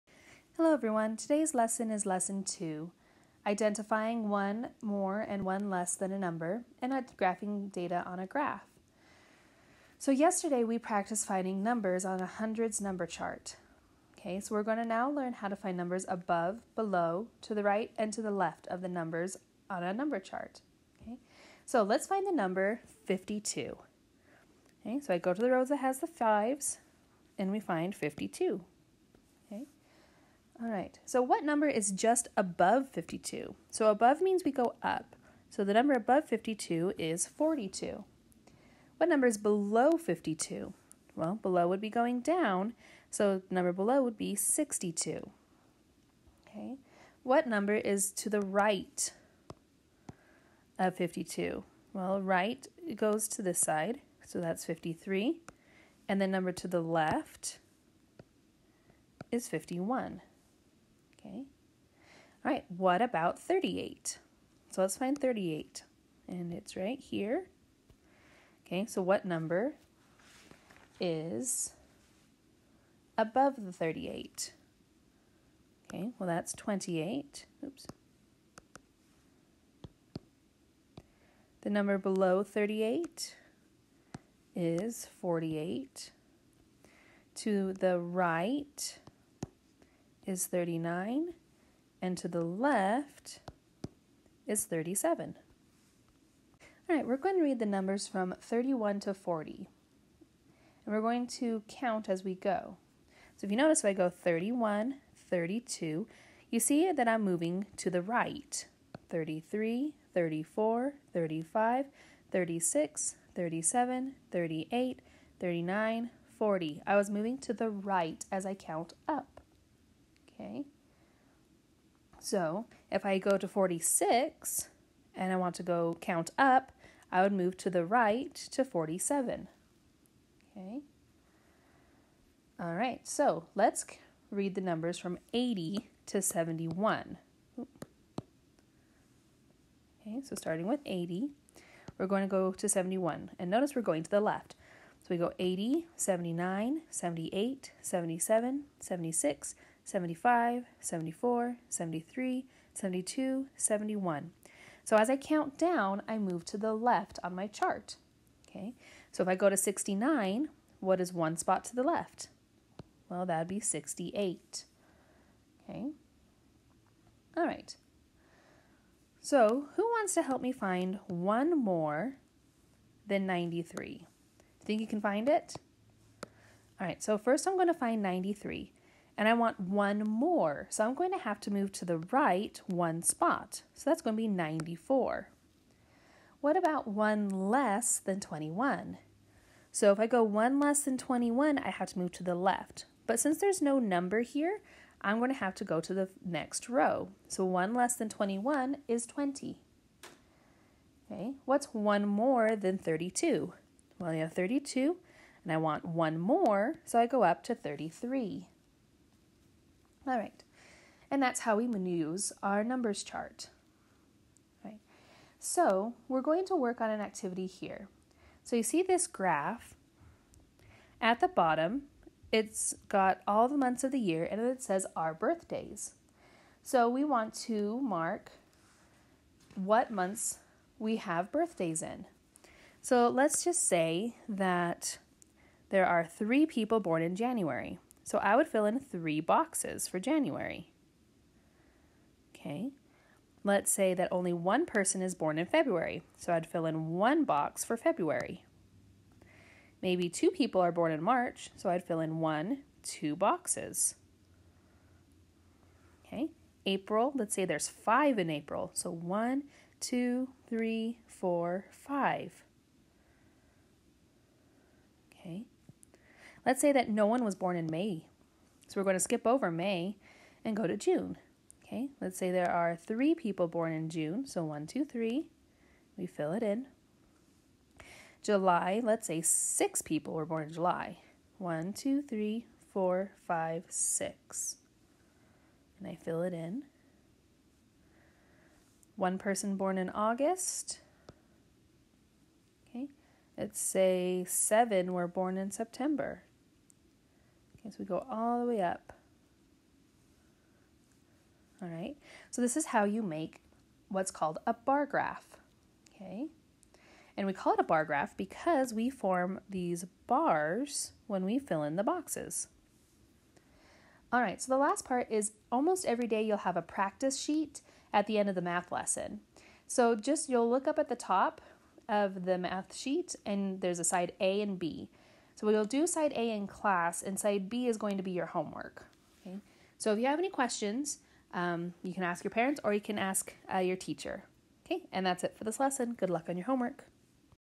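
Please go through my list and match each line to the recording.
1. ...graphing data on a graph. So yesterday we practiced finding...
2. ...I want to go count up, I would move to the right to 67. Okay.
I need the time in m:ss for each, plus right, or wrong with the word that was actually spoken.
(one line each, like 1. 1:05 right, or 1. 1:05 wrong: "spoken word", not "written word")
1. 0:07 right
2. 2:05 wrong: "47", not "67".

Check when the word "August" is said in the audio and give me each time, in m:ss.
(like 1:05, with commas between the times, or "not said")
4:49.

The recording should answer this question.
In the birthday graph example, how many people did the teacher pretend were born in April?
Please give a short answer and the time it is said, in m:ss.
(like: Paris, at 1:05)
5, at 4:17.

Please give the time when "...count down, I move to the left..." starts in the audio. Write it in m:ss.
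2:35.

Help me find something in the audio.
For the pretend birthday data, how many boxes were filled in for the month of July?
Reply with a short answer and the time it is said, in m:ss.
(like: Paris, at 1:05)
6, at 4:39.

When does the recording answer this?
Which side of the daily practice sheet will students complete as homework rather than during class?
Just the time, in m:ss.
5:27.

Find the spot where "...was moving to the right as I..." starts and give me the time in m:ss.
1:56.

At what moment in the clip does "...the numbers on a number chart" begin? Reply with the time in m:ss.
0:18.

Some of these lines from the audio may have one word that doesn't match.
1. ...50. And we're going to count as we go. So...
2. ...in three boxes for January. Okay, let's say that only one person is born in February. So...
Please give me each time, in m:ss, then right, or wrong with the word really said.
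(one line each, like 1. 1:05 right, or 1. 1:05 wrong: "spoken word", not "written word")
1. 1:39 wrong: "40", not "50"
2. 3:58 right.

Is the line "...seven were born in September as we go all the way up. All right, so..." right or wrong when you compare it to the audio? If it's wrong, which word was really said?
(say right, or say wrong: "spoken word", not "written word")
right.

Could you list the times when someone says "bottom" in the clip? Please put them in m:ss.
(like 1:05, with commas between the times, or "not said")
3:41.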